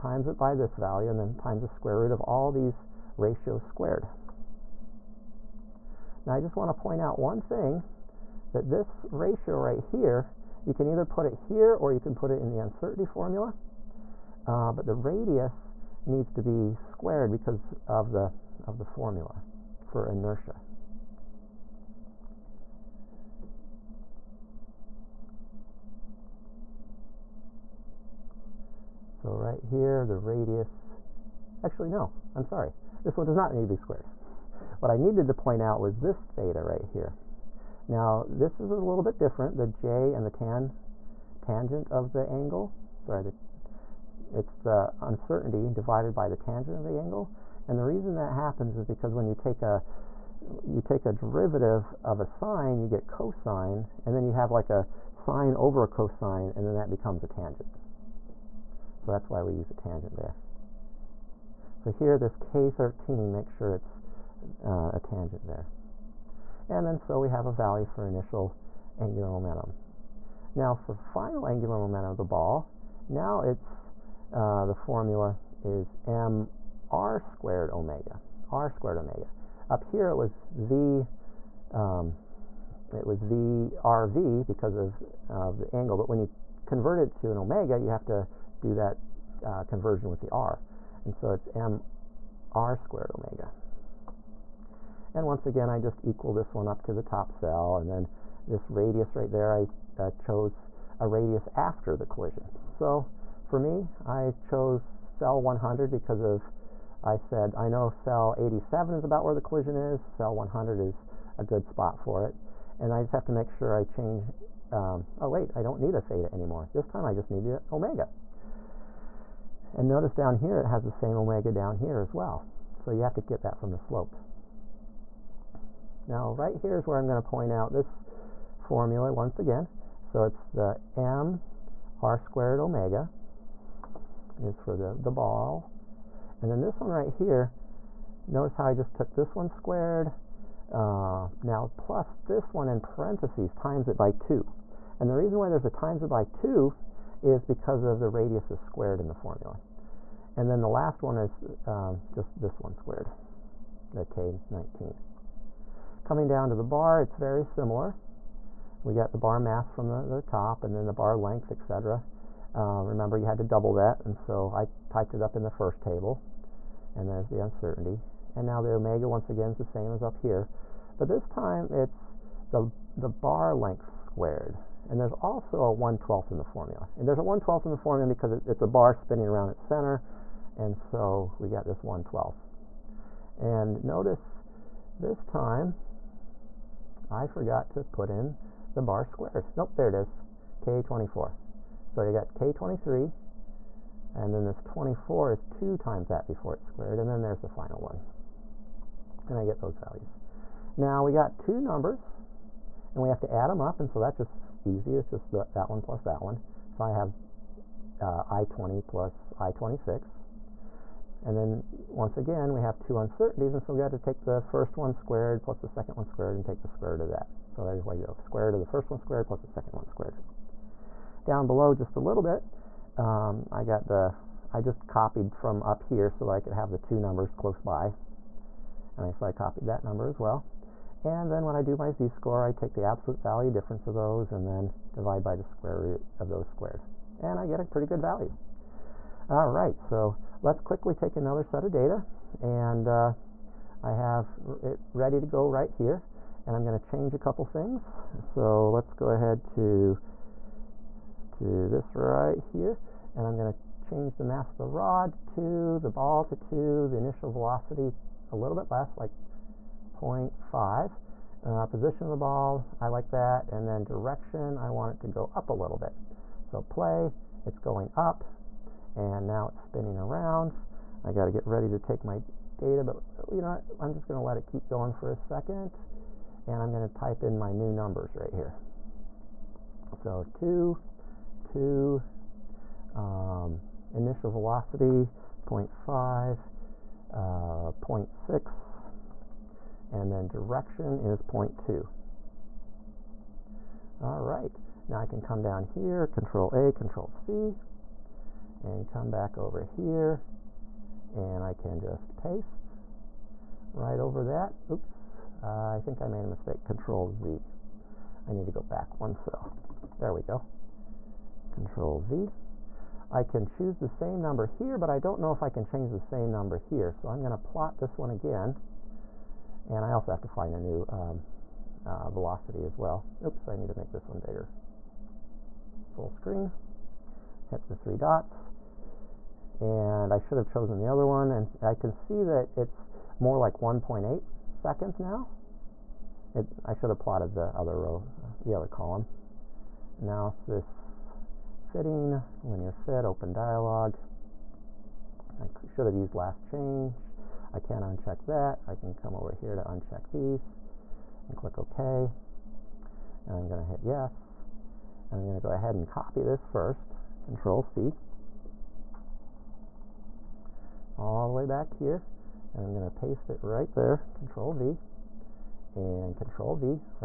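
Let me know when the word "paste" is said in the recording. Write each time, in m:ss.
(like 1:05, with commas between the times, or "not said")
5:02, 6:02.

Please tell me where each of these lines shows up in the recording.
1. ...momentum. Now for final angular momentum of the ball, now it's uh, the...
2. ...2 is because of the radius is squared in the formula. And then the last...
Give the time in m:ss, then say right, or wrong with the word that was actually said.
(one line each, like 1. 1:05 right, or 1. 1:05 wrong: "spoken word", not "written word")
1. 1:09 right
2. 2:26 right.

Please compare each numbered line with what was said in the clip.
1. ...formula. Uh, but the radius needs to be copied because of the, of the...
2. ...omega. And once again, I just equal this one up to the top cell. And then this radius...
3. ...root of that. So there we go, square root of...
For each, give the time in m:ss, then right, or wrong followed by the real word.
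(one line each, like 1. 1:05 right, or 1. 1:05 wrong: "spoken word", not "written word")
1. 0:13 wrong: "squared", not "copied"
2. 1:33 right
3. 3:36 right.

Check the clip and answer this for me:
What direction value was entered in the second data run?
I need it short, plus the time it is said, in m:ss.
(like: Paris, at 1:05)
0.2, at 4:50.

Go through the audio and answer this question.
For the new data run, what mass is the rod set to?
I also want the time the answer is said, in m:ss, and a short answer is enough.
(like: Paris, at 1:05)
2, at 4:14.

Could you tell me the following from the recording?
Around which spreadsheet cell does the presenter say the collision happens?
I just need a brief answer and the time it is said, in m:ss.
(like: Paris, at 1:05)
87, at 1:47.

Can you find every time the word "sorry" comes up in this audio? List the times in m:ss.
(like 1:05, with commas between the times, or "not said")
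0:32, 0:43.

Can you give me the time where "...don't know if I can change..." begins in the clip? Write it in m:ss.
5:14.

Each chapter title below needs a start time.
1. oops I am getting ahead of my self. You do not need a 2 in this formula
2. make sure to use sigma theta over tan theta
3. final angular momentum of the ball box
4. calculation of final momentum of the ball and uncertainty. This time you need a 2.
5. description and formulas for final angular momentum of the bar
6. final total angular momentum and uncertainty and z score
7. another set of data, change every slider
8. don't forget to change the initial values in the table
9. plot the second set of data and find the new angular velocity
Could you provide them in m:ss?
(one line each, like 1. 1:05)
1. 0:17
2. 0:37
3. 1:12
4. 2:11
5. 2:36
6. 3:22
7. 4:01
8. 4:42
9. 5:17.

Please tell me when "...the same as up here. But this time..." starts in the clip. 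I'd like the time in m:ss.
2:49.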